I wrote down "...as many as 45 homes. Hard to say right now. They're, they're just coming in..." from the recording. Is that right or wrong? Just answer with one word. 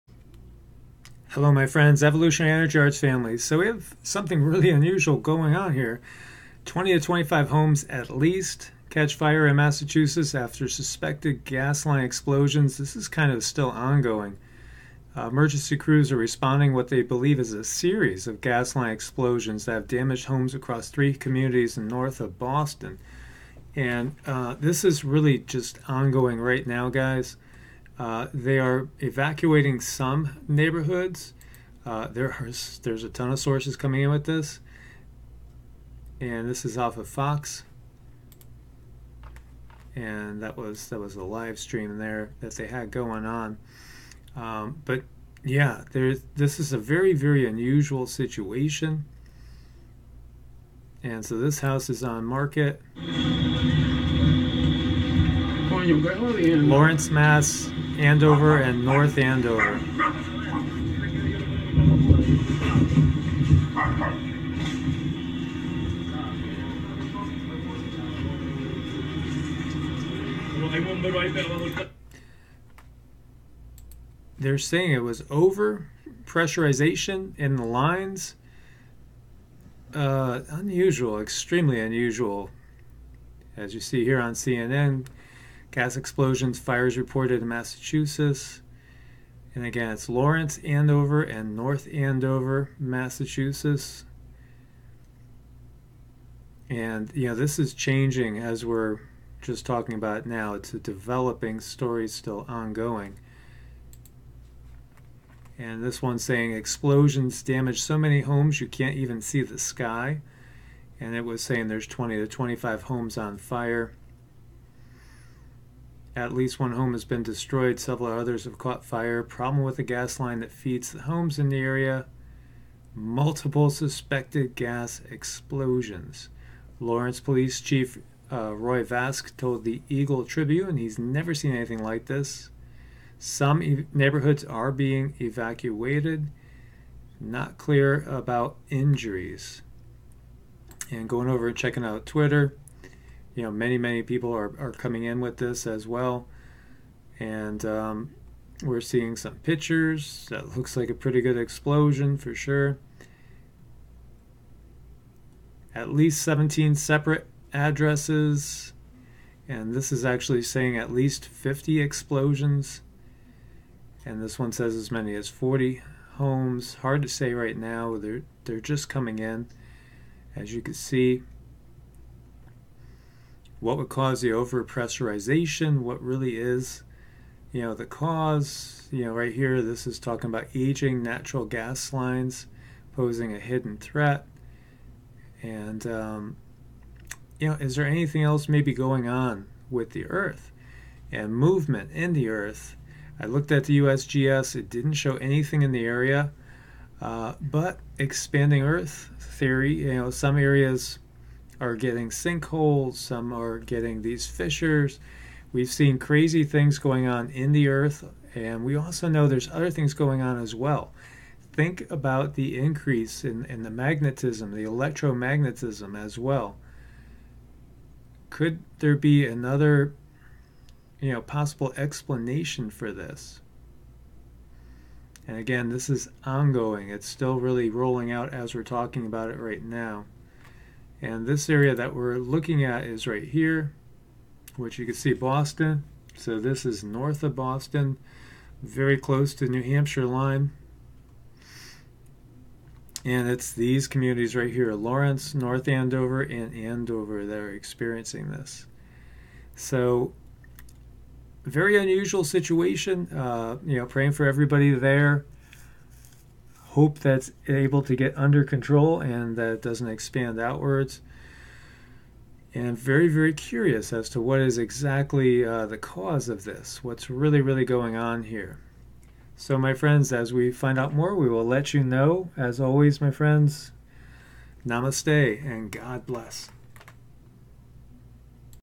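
wrong.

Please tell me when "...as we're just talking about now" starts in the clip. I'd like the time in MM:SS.
01:38.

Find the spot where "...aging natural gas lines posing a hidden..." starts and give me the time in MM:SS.
03:00.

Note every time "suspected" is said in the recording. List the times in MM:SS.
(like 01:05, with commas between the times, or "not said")
00:10, 02:03.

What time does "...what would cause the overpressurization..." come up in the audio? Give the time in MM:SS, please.
02:53.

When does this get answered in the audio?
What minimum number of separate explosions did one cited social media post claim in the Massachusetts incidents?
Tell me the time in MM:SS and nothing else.
02:41.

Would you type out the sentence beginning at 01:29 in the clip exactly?
And again, it's Lawrence, Andover, and North Andover, Massachusetts.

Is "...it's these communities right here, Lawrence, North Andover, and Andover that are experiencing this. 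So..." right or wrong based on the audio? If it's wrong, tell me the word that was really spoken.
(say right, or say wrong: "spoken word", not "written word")
right.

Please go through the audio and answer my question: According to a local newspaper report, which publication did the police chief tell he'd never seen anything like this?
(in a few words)
Eagle Tribune.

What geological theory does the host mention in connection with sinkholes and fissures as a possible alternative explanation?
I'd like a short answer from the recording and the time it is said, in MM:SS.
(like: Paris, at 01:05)
expanding Earth theory, at 03:17.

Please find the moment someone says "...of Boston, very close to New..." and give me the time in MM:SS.
03:57.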